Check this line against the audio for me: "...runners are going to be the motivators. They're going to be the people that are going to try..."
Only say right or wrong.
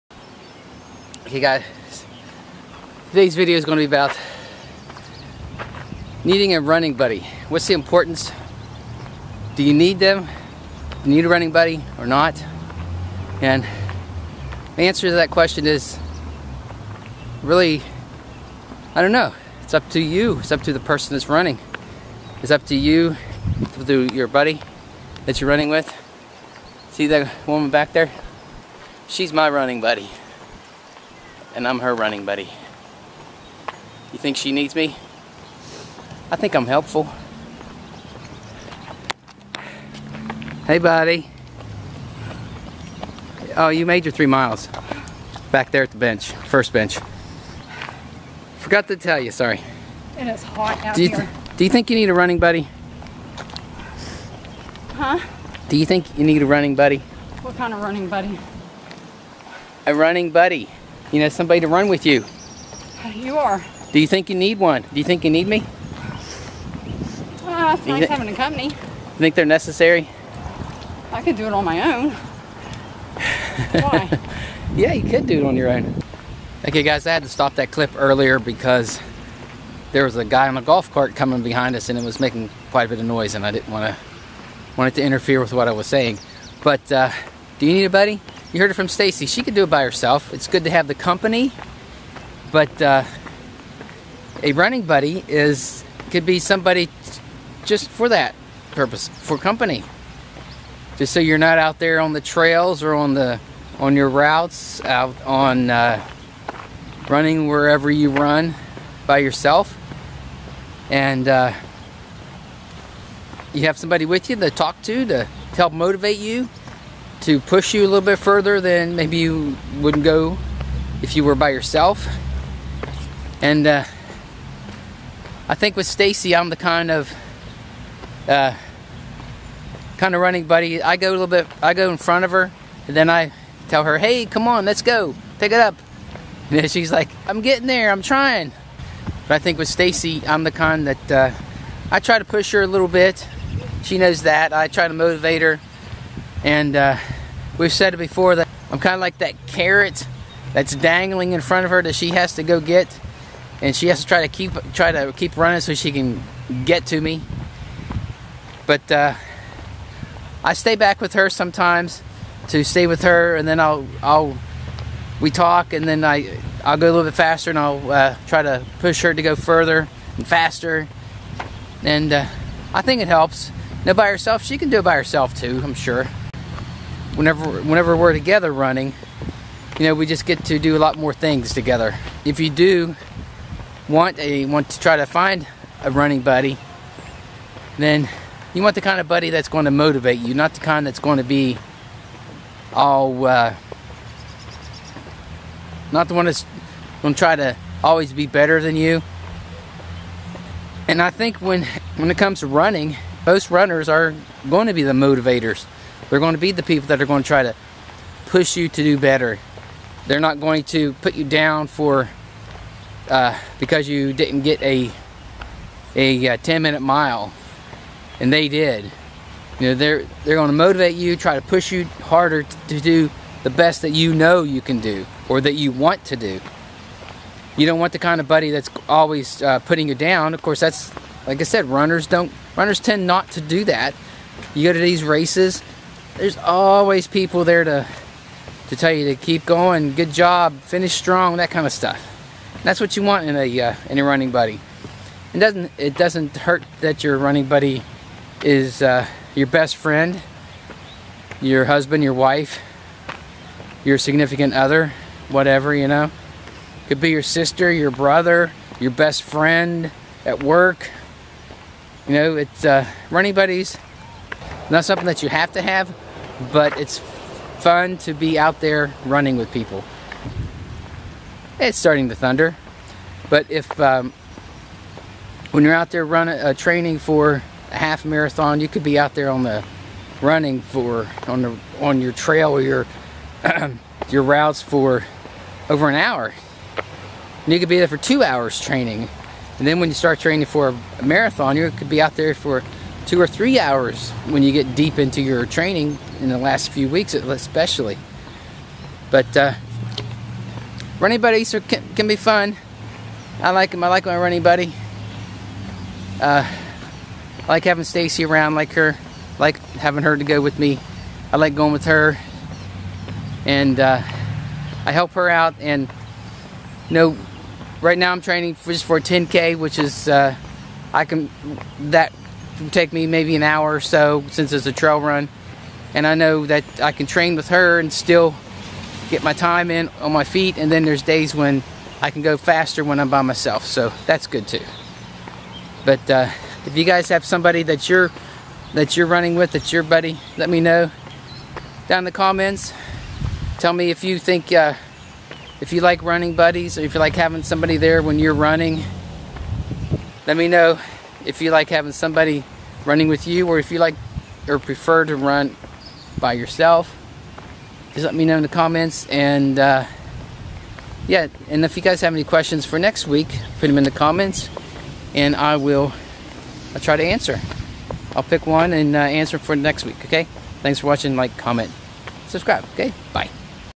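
right.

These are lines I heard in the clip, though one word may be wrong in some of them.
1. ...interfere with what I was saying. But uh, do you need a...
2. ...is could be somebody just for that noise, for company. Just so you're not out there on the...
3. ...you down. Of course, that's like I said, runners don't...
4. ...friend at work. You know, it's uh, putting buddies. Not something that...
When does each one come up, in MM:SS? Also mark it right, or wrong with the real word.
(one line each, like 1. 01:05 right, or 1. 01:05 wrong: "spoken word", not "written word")
1. 01:25 right
2. 01:35 wrong: "purpose", not "noise"
3. 03:49 right
4. 04:19 wrong: "running", not "putting".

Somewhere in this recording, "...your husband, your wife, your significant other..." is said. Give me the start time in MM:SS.
04:11.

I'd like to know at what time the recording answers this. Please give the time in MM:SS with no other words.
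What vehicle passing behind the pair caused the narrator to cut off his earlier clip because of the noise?
01:20.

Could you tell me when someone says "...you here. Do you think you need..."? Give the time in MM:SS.
00:51.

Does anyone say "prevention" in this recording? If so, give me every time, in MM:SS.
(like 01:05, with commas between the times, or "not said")
not said.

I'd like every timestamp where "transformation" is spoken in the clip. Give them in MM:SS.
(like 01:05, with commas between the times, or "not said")
not said.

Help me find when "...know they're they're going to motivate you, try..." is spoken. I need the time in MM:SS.
03:39.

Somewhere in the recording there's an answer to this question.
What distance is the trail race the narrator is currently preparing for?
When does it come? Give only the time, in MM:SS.
05:18.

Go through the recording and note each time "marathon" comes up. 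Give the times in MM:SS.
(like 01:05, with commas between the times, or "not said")
04:38, 04:51.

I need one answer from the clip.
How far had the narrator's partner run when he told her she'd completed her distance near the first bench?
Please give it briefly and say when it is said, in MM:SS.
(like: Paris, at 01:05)
3 miles, at 00:44.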